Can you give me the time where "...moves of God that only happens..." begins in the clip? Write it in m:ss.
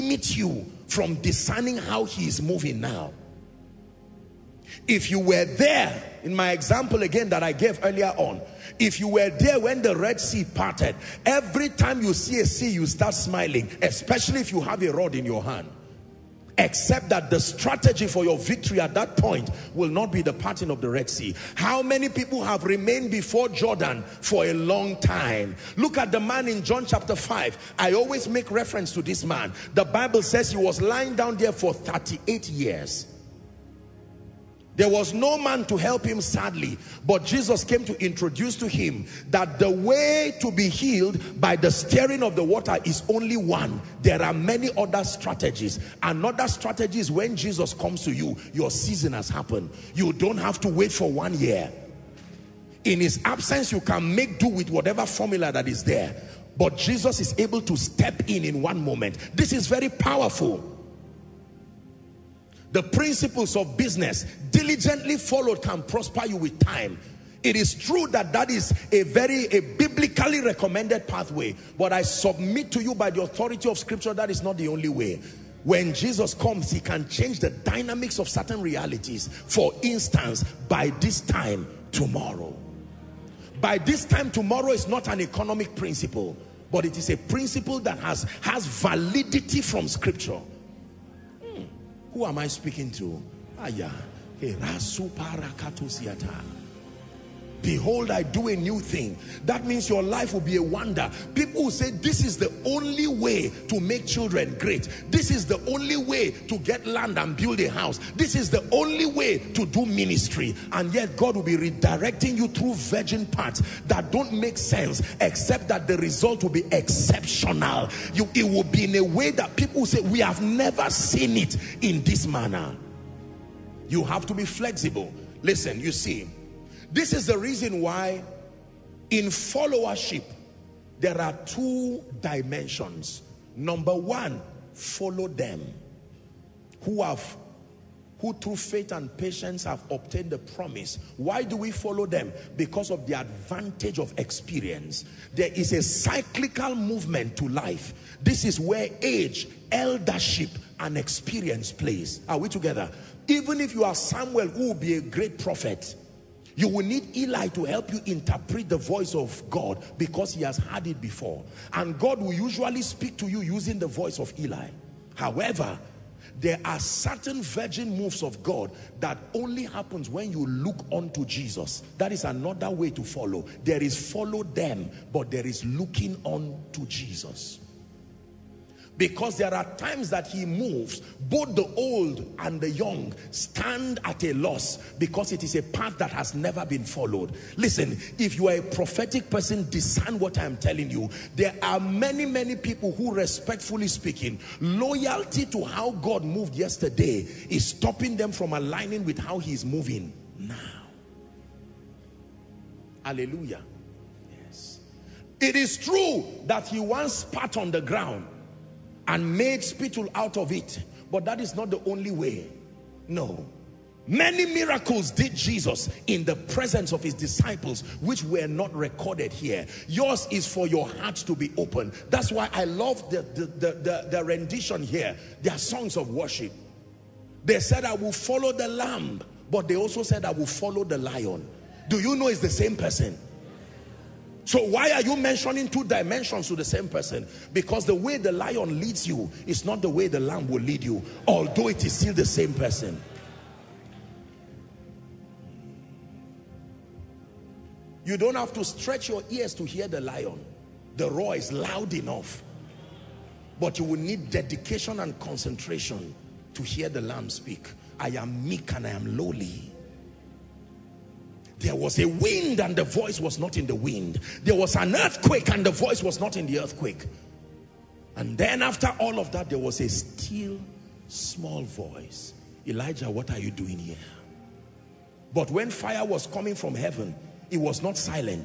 2:47.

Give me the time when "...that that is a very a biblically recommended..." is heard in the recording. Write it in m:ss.
1:08.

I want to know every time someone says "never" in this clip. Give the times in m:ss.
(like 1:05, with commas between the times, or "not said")
2:00, 3:06.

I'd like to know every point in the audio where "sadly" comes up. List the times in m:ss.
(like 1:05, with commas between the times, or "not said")
0:36.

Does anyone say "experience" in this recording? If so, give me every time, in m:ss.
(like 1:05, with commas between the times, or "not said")
2:24, 2:30.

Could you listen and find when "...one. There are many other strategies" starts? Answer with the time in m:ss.
0:43.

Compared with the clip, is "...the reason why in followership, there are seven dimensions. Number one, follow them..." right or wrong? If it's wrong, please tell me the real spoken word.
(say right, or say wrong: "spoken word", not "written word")
wrong: "two", not "seven".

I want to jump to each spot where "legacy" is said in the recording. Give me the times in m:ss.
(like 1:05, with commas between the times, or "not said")
not said.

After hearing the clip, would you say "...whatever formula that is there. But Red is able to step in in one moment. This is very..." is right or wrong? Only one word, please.
wrong.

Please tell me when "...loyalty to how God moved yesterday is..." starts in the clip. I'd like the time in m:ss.
3:14.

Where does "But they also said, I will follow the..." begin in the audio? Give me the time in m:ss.
3:49.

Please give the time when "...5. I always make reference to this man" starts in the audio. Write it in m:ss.
0:27.